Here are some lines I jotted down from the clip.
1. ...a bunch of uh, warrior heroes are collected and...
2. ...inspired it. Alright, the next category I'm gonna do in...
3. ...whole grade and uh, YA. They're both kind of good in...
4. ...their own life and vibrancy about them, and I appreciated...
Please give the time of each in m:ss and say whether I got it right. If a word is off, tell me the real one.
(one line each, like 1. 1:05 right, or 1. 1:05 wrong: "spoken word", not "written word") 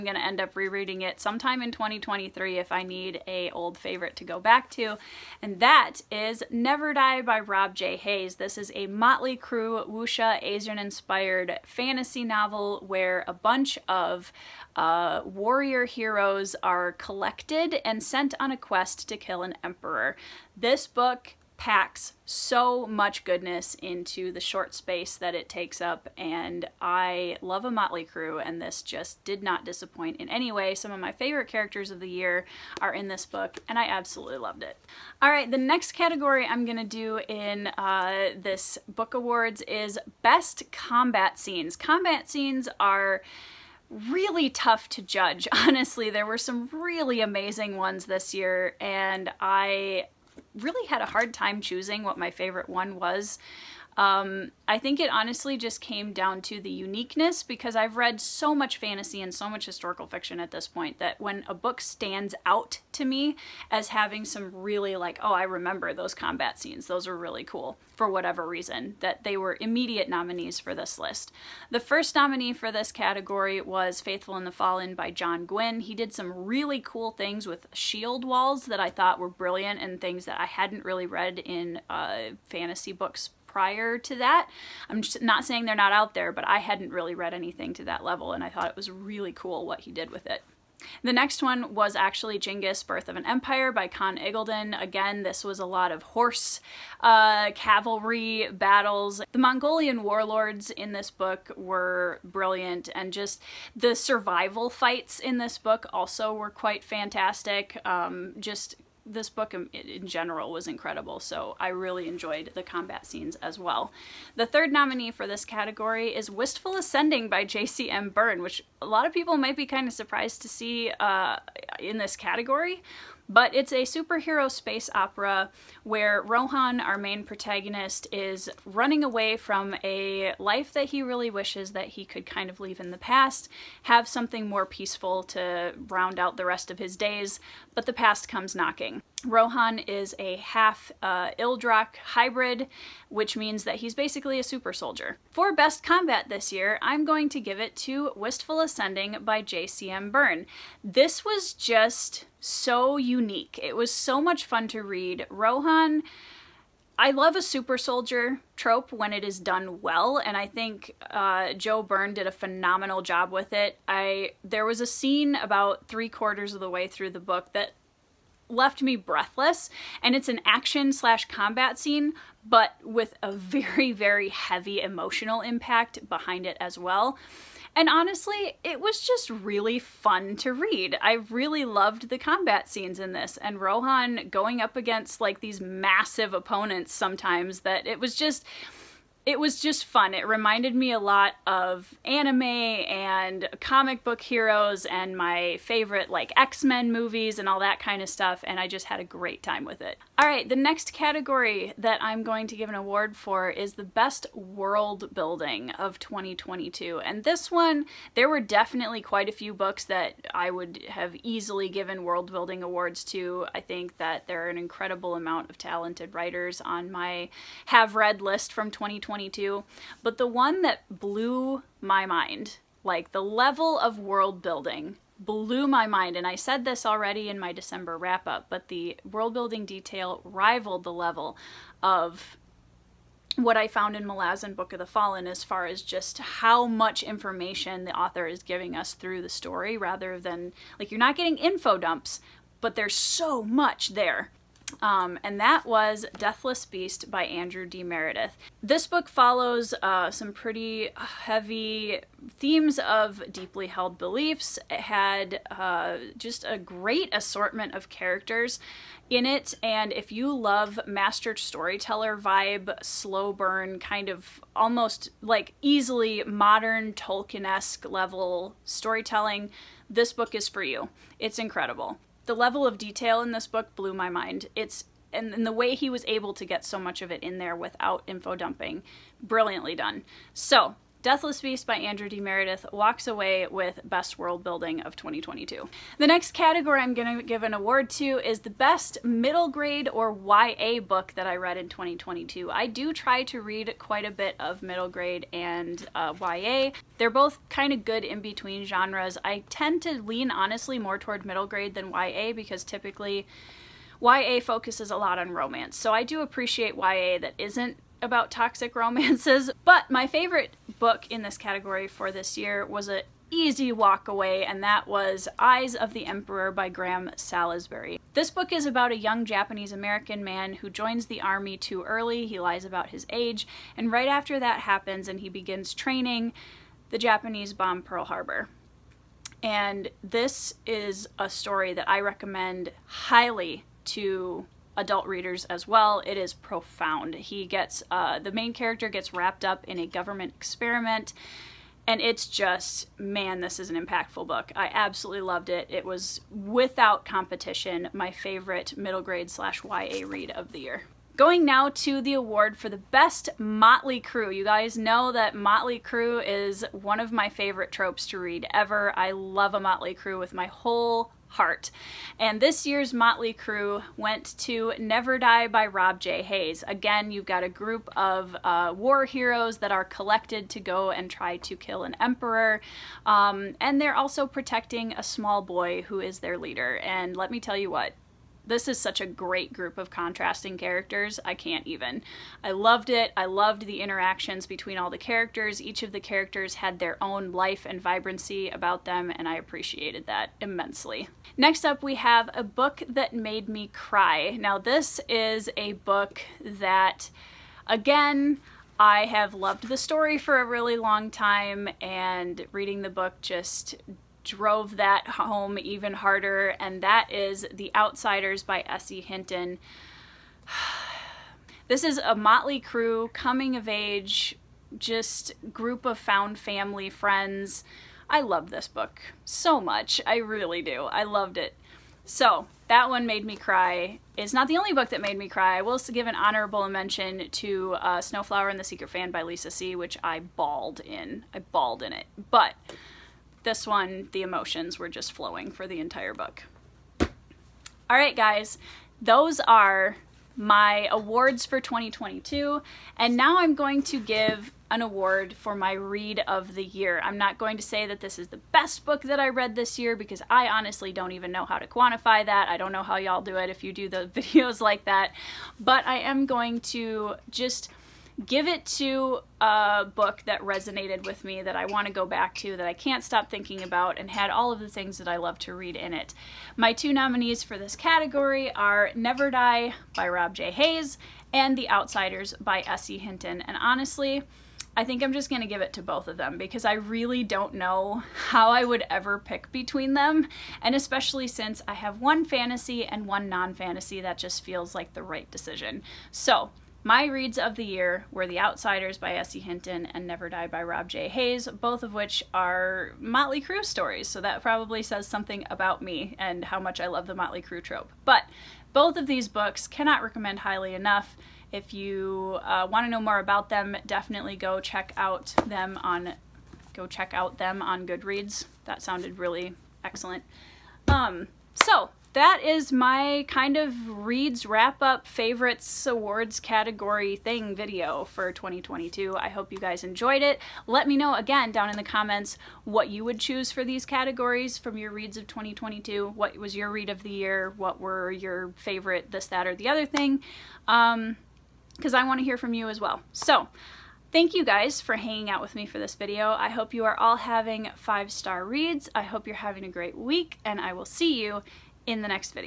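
1. 0:13 right
2. 0:34 wrong: "loved", not "inspired"
3. 4:54 wrong: "middle", not "whole"
4. 6:26 right.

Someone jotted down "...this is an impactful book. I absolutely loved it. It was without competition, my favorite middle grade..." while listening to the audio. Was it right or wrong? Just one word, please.
right.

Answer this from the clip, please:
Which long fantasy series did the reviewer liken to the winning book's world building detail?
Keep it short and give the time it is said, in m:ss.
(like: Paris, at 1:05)
Malazan Book of the Fallen, at 3:54.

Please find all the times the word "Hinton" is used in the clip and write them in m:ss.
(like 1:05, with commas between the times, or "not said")
6:48, 7:52, 8:09.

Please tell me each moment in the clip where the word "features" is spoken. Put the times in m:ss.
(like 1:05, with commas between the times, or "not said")
not said.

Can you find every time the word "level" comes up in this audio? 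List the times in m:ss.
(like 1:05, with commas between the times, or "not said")
1:28, 3:43, 3:50, 4:27, 4:32.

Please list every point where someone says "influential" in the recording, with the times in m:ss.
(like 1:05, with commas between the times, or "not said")
not said.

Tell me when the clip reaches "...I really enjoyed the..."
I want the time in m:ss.
1:51.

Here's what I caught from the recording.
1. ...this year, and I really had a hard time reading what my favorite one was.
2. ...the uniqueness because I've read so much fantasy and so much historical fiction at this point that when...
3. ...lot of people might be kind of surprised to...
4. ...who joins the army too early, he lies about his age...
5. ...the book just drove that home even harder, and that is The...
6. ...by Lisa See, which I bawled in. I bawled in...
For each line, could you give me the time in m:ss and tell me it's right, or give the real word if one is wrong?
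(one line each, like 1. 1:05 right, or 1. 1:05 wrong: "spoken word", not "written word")
1. 0:48 wrong: "choosing", not "reading"
2. 0:56 right
3. 1:58 right
4. 5:20 right
5. 6:42 right
6. 7:09 right.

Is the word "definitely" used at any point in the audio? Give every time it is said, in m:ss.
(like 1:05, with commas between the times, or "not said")
3:28, 8:23.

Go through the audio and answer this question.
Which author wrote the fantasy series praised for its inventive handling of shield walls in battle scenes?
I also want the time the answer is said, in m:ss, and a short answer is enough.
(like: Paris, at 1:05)
John Gwynne, at 1:15.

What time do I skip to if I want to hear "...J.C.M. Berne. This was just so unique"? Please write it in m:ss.
2:29.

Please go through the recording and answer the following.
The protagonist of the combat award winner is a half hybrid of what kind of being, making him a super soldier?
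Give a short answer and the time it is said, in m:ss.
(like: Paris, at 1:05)
Ildrak, at 2:21.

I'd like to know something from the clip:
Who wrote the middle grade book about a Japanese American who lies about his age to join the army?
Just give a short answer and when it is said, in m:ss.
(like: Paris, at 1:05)
Graham Salisbury, at 5:16.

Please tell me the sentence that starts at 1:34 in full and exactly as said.
Again, this was a lot of horse uh, cavalry battles.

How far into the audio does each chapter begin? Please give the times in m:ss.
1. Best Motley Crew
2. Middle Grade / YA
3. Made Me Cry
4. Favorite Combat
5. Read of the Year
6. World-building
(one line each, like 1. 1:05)
1. 5:49
2. 4:45
3. 6:30
4. 0:34
5. 7:21
6. 3:19.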